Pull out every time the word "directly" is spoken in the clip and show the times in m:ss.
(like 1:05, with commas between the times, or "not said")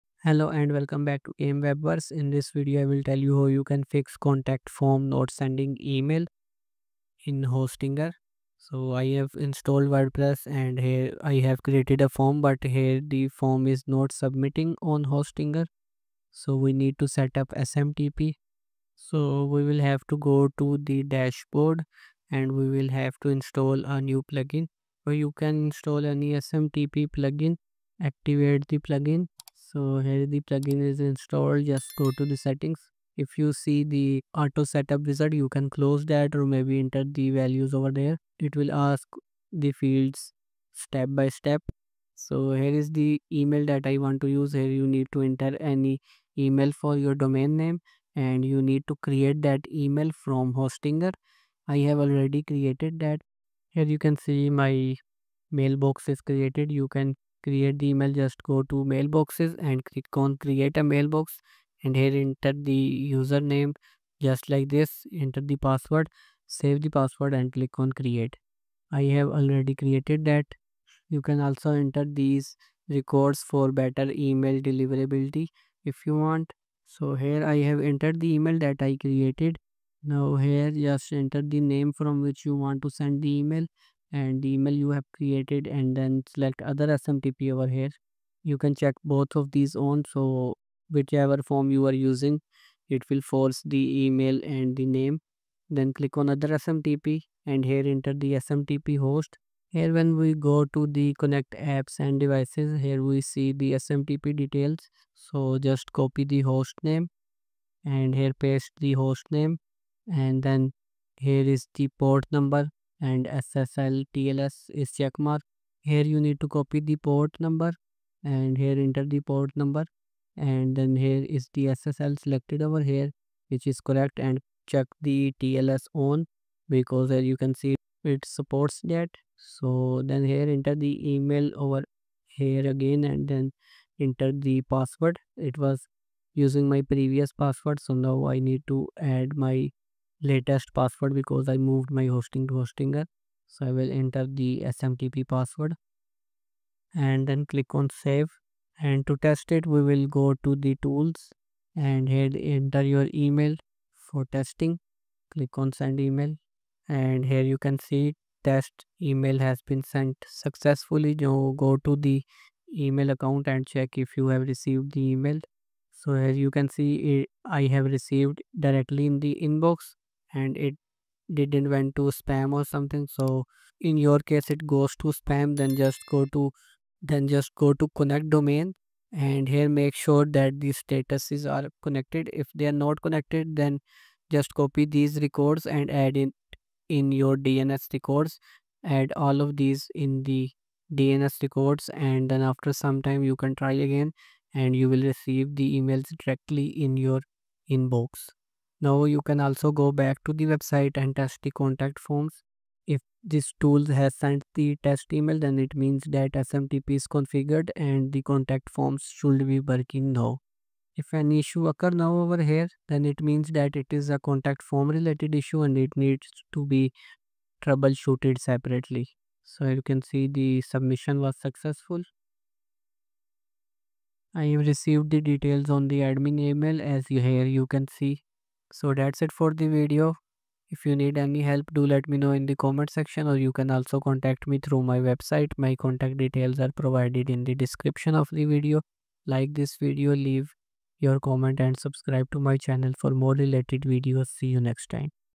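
2:48, 3:16.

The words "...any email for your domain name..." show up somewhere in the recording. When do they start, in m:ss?
0:45.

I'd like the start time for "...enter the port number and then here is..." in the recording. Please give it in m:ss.
1:58.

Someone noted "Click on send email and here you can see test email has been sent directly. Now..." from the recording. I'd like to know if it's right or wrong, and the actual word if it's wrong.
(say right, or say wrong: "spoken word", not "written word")
wrong: "successfully", not "directly".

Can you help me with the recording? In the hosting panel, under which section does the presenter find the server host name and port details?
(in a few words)
Connect apps and devices.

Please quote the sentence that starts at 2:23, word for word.
So I will enter the SMTP password and then click on save.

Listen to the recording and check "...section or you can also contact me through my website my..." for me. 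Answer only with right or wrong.
right.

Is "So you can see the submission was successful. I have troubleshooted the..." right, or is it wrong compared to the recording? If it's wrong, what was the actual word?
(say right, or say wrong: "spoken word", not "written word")
wrong: "received", not "troubleshooted".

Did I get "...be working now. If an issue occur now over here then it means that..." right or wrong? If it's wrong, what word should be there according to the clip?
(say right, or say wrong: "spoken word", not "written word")
right.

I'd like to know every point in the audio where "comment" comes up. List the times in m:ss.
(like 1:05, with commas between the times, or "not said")
3:52, 4:01.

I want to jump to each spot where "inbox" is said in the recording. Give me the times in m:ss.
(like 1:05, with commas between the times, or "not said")
2:49, 3:17.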